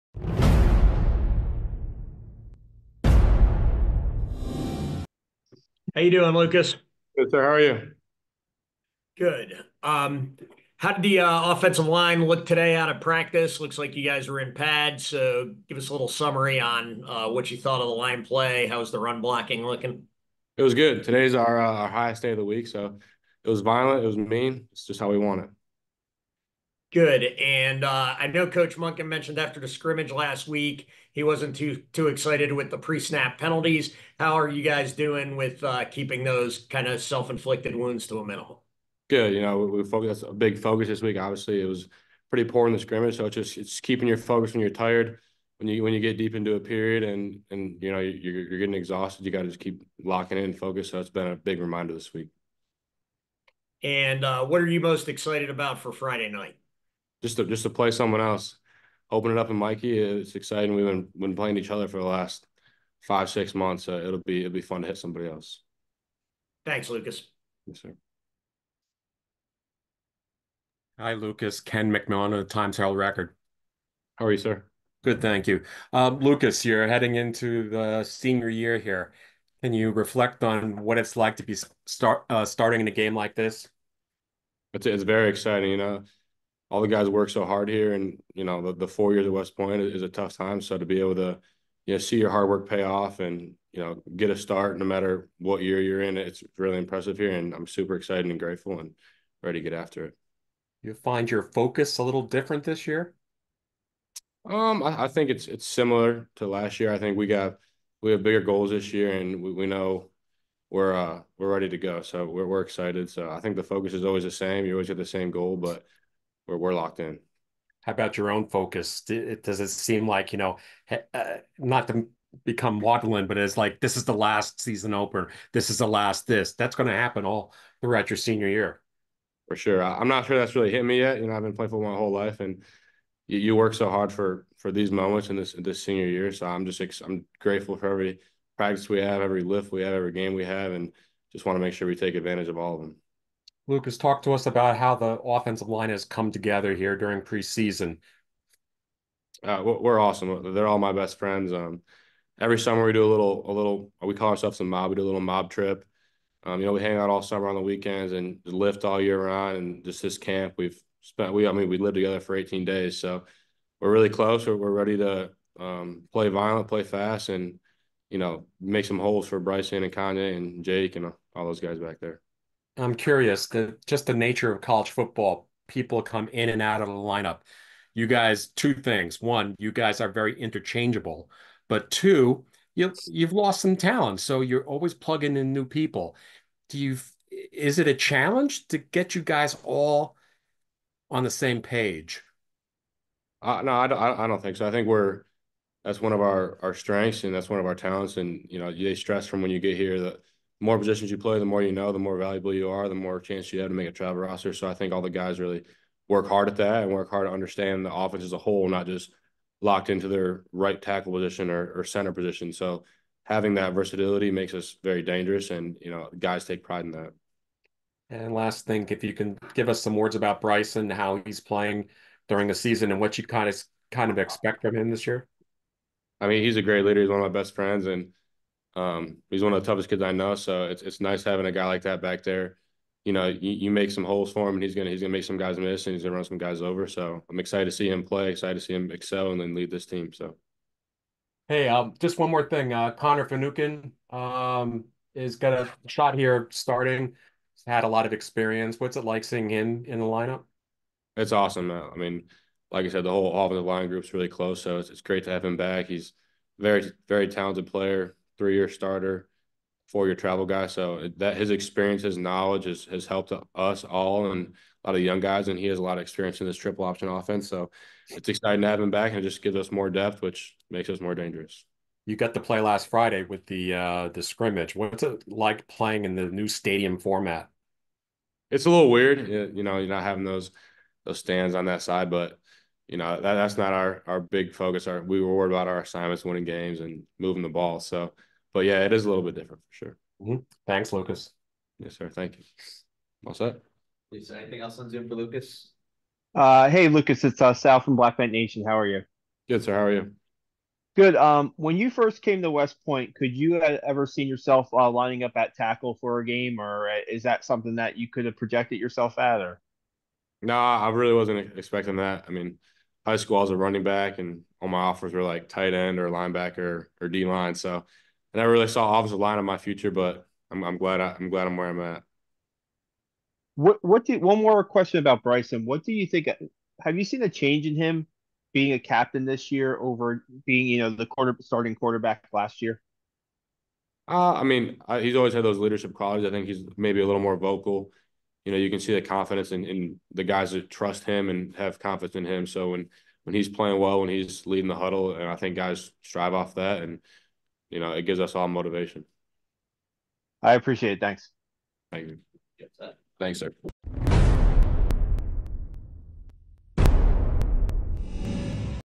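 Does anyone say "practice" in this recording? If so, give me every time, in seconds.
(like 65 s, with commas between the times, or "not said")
13 s, 138 s.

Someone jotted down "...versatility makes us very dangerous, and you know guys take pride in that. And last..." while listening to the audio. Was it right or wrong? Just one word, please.
right.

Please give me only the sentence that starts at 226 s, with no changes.
I mean, he's a great leader.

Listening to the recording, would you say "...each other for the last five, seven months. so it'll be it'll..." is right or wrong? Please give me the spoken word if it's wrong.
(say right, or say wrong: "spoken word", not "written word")
wrong: "six", not "seven".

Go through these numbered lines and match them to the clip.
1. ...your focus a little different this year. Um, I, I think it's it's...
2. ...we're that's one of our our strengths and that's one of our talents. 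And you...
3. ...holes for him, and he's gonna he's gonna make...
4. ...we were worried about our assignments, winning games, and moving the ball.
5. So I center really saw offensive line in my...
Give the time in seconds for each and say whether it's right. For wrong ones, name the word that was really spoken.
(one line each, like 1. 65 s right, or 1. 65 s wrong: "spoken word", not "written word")
1. 101 s right
2. 194 s right
3. 234 s right
4. 285 s right
5. 317 s wrong: "never", not "center".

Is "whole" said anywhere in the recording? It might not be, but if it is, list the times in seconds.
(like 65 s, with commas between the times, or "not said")
131 s, 208 s, 253 s.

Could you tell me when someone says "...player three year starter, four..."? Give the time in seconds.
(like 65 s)
257 s.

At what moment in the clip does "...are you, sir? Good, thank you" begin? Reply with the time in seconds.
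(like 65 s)
74 s.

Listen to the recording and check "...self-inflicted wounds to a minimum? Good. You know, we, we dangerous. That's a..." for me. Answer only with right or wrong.
wrong.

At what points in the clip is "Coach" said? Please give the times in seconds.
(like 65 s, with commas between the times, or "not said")
28 s.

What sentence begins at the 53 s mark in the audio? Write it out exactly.
And uh, what are you most excited about for Friday night?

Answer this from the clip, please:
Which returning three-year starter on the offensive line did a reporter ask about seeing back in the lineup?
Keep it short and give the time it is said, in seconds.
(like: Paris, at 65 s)
Connor Finucane, at 242 s.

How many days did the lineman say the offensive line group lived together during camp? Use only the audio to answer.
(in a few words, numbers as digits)
18.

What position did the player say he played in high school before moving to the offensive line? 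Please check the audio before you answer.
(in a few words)
running back.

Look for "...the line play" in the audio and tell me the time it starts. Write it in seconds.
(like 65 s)
17 s.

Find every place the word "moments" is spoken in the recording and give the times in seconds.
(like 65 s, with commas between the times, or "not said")
134 s.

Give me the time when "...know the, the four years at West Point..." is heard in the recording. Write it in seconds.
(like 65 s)
88 s.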